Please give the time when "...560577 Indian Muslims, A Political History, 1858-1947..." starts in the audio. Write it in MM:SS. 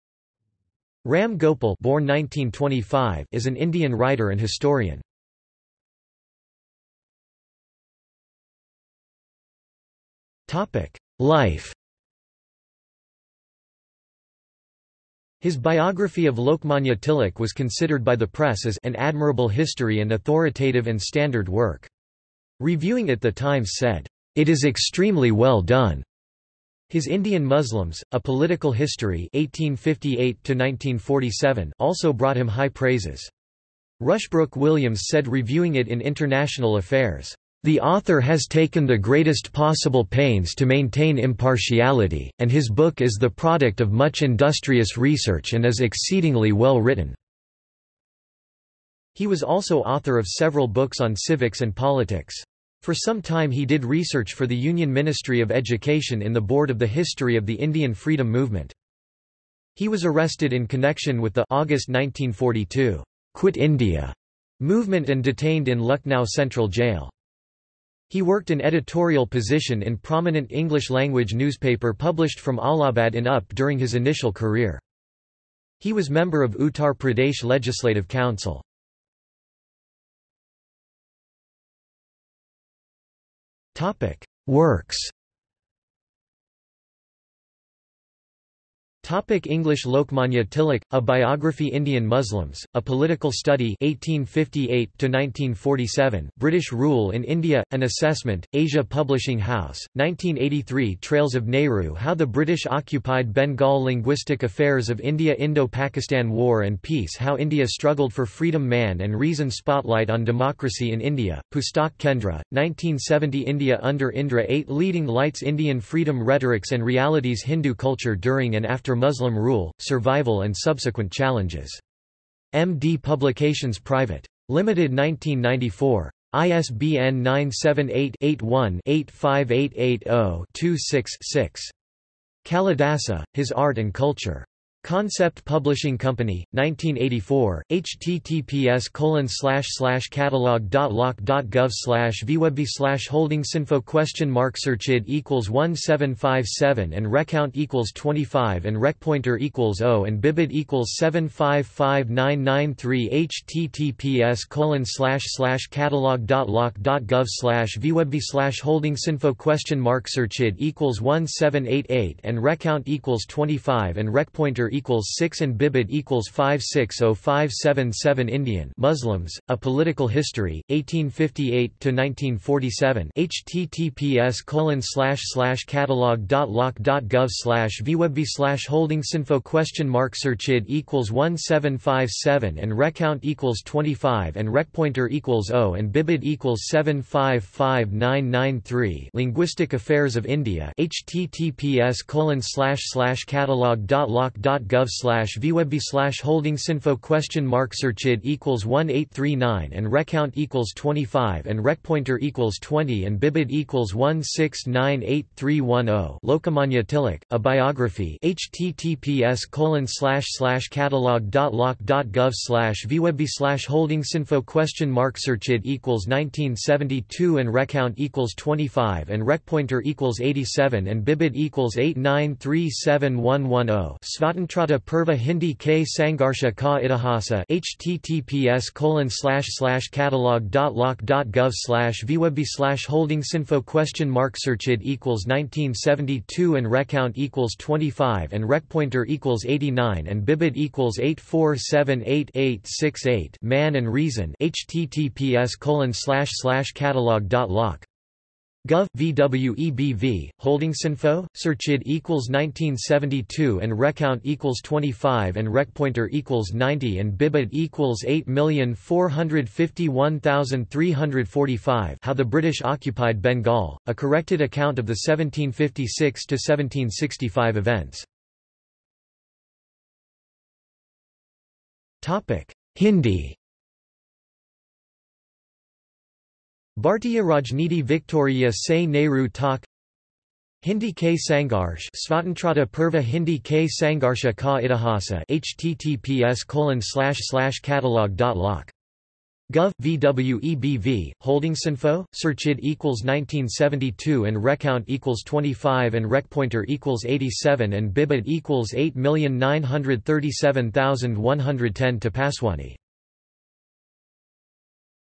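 02:46.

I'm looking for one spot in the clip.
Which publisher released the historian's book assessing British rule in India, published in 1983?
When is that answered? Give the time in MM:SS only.
01:38.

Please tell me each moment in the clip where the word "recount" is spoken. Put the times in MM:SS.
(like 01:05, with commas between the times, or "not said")
02:27, 02:42, 03:02, 03:19, 03:37, 03:56, 04:13, 04:54.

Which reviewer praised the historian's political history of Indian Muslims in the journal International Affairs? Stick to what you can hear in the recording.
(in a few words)
Rushbrook Williams.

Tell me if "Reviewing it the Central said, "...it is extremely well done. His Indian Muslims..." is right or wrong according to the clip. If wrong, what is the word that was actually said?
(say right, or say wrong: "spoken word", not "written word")
wrong: "Times", not "Central".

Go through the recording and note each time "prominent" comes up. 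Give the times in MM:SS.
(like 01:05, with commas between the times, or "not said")
01:09.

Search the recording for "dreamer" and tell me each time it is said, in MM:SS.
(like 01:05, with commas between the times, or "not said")
not said.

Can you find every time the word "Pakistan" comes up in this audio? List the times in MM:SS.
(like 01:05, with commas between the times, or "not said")
01:45.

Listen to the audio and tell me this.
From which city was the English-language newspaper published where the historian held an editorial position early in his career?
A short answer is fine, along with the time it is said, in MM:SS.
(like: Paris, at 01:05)
Allahabad, at 01:12.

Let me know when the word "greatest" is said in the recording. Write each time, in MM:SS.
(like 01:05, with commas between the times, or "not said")
00:38.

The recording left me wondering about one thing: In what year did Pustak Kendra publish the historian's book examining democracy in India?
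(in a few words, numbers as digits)
1970.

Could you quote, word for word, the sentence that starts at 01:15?
He was member of Uttar Pradesh Legislative Council.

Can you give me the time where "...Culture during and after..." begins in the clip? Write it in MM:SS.
01:57.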